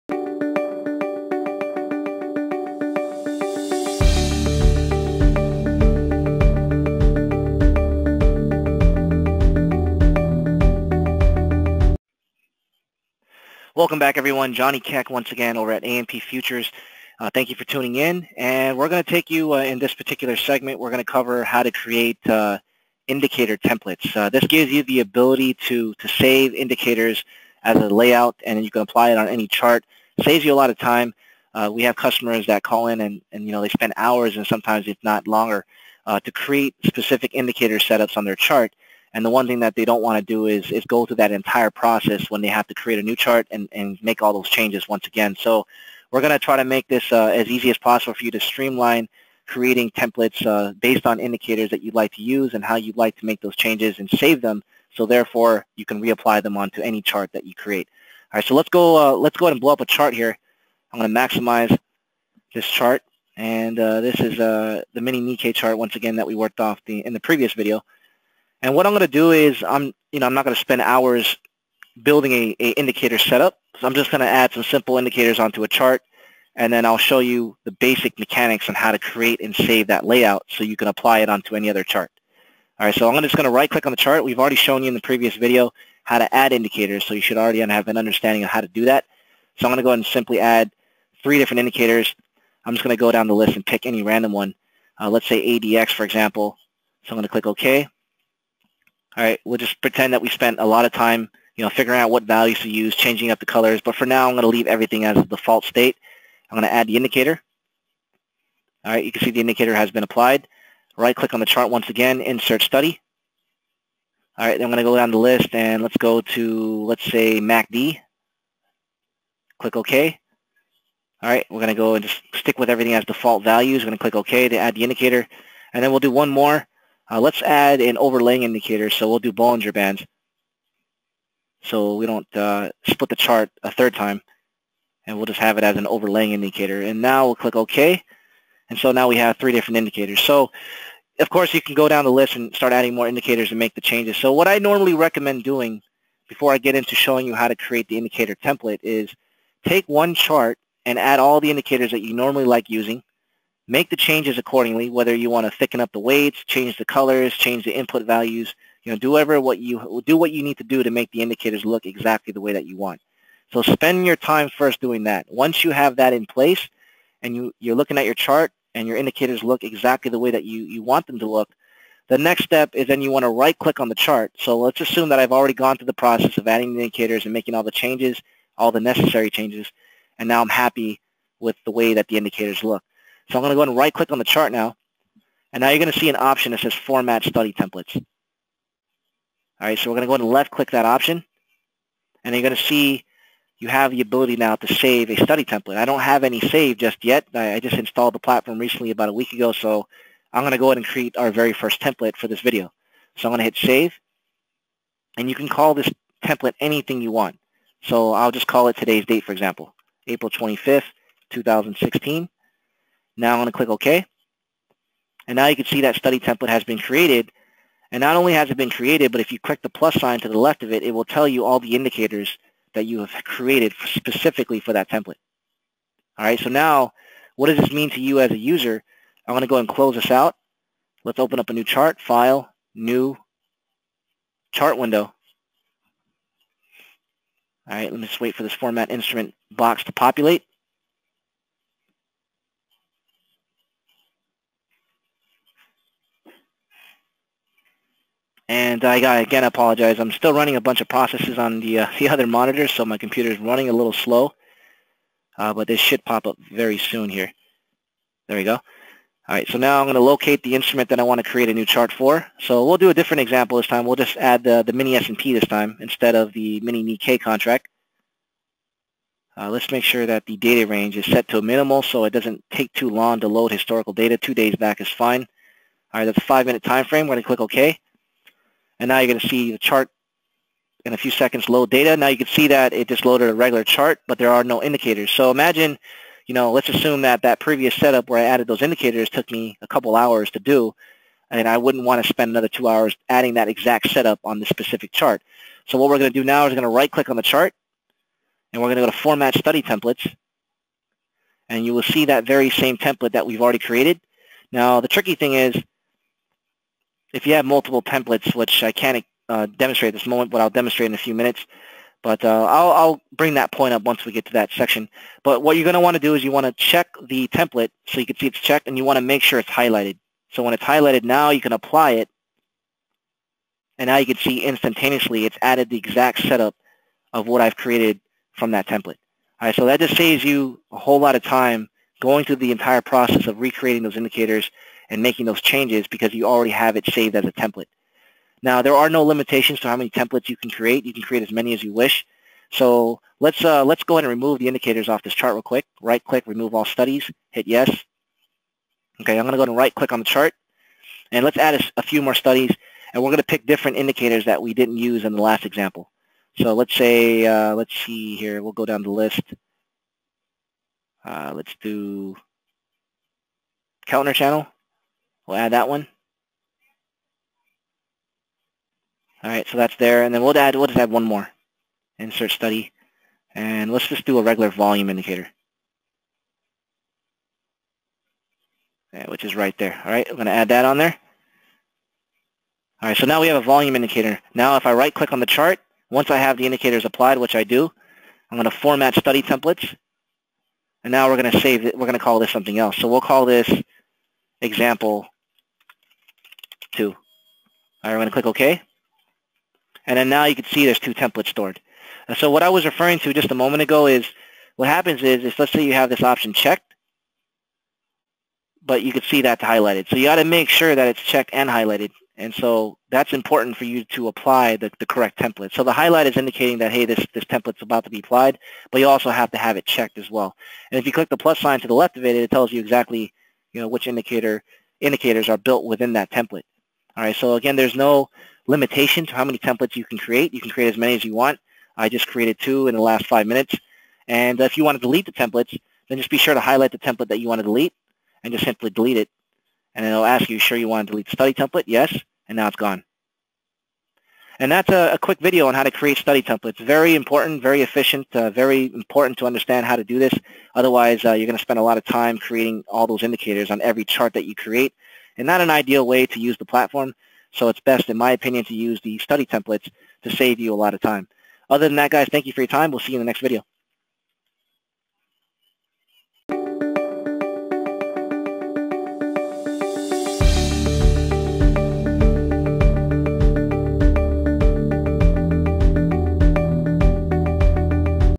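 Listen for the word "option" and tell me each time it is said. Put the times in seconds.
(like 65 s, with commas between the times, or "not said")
186 s, 190 s, 406 s.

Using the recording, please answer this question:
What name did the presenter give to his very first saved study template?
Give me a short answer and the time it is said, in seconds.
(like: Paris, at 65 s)
April 25th, 2016, at 210 s.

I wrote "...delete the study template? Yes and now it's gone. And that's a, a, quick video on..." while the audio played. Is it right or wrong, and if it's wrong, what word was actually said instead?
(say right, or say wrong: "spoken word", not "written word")
right.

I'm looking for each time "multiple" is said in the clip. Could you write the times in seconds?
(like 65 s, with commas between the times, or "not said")
307 s.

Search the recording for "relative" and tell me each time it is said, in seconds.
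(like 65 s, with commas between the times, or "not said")
not said.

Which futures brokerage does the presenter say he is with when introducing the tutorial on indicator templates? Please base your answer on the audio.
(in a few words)
AMP Futures.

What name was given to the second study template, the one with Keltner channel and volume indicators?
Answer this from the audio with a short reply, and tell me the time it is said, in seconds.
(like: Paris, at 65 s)
example 2, at 394 s.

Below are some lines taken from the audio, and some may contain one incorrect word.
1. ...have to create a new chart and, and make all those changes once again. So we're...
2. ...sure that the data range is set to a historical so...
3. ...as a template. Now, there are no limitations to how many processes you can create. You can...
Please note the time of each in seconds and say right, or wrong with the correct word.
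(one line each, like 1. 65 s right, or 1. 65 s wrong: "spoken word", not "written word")
1. 42 s right
2. 269 s wrong: "minimal", not "historical"
3. 337 s wrong: "templates", not "processes".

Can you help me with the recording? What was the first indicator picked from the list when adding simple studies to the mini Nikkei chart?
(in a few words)
ADX.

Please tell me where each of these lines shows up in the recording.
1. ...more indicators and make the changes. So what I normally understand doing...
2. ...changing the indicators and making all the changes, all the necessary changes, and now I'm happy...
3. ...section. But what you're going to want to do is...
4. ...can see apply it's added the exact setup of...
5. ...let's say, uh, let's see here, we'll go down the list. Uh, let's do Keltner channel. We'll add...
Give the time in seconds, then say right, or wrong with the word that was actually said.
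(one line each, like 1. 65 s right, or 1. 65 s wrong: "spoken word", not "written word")
1. 142 s wrong: "recommend", not "understand"
2. 176 s wrong: "adding", not "changing"
3. 314 s right
4. 324 s wrong: "instantaneously", not "apply"
5. 356 s right.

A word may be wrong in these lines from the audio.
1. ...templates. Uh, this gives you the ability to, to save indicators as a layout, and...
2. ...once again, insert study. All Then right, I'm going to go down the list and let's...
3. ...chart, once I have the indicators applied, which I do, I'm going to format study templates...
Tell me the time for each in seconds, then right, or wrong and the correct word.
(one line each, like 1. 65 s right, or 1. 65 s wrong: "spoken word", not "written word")
1. 23 s right
2. 111 s right
3. 385 s right.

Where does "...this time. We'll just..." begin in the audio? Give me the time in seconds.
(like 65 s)
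263 s.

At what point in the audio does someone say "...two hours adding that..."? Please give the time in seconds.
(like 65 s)
292 s.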